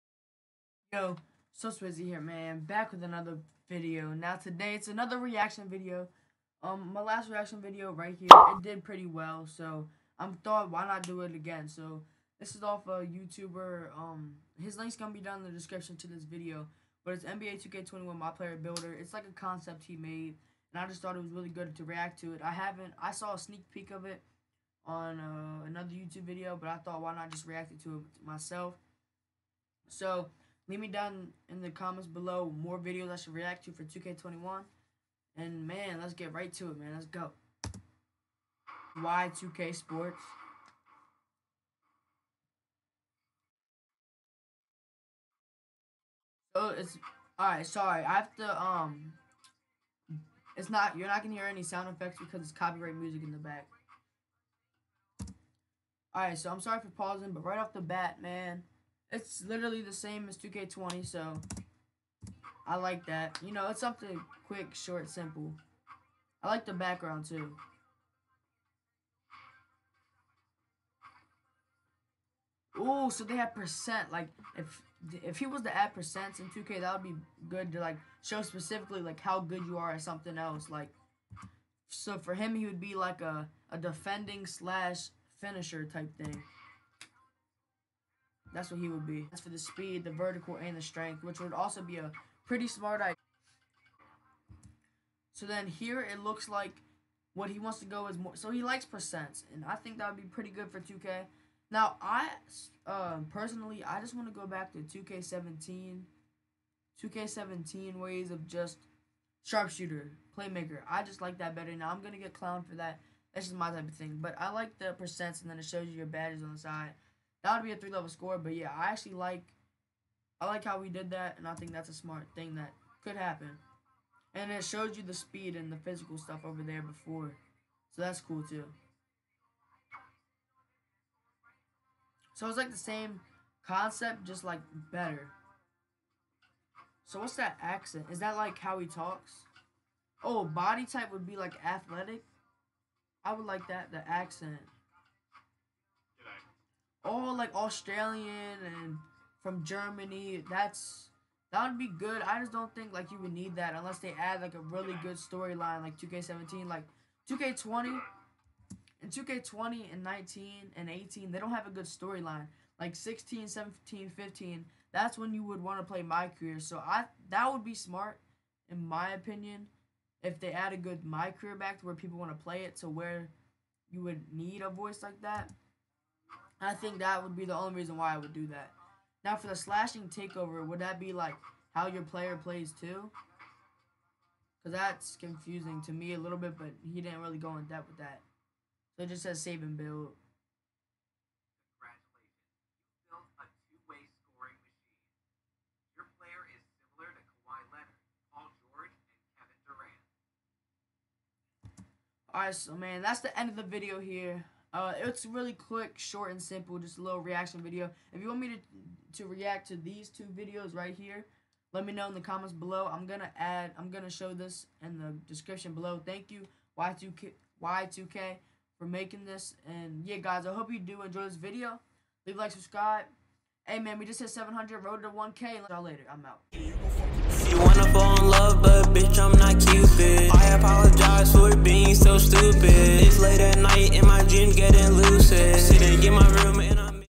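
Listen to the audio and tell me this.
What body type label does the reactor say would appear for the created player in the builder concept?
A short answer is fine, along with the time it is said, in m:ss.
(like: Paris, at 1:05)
athletic, at 2:21.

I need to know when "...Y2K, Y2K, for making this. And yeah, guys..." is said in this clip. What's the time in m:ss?
3:36.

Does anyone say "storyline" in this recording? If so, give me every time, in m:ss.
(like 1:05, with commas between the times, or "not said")
2:35, 2:41.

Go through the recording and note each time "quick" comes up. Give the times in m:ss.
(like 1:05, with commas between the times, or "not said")
1:04, 3:25.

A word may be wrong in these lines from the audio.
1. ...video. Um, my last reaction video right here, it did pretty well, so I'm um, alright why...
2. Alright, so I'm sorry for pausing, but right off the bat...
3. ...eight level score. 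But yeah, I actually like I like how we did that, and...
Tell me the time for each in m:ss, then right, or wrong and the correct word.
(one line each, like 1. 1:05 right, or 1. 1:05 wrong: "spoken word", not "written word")
1. 0:05 wrong: "thought", not "alright"
2. 0:56 right
3. 1:57 wrong: "three", not "eight".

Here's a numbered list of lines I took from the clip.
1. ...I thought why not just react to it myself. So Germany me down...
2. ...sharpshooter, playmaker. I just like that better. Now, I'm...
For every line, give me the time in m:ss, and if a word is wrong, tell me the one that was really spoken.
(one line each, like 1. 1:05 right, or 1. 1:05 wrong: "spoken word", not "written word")
1. 0:26 wrong: "Leave", not "Germany"
2. 1:49 right.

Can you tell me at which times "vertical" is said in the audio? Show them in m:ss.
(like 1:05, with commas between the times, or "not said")
1:30.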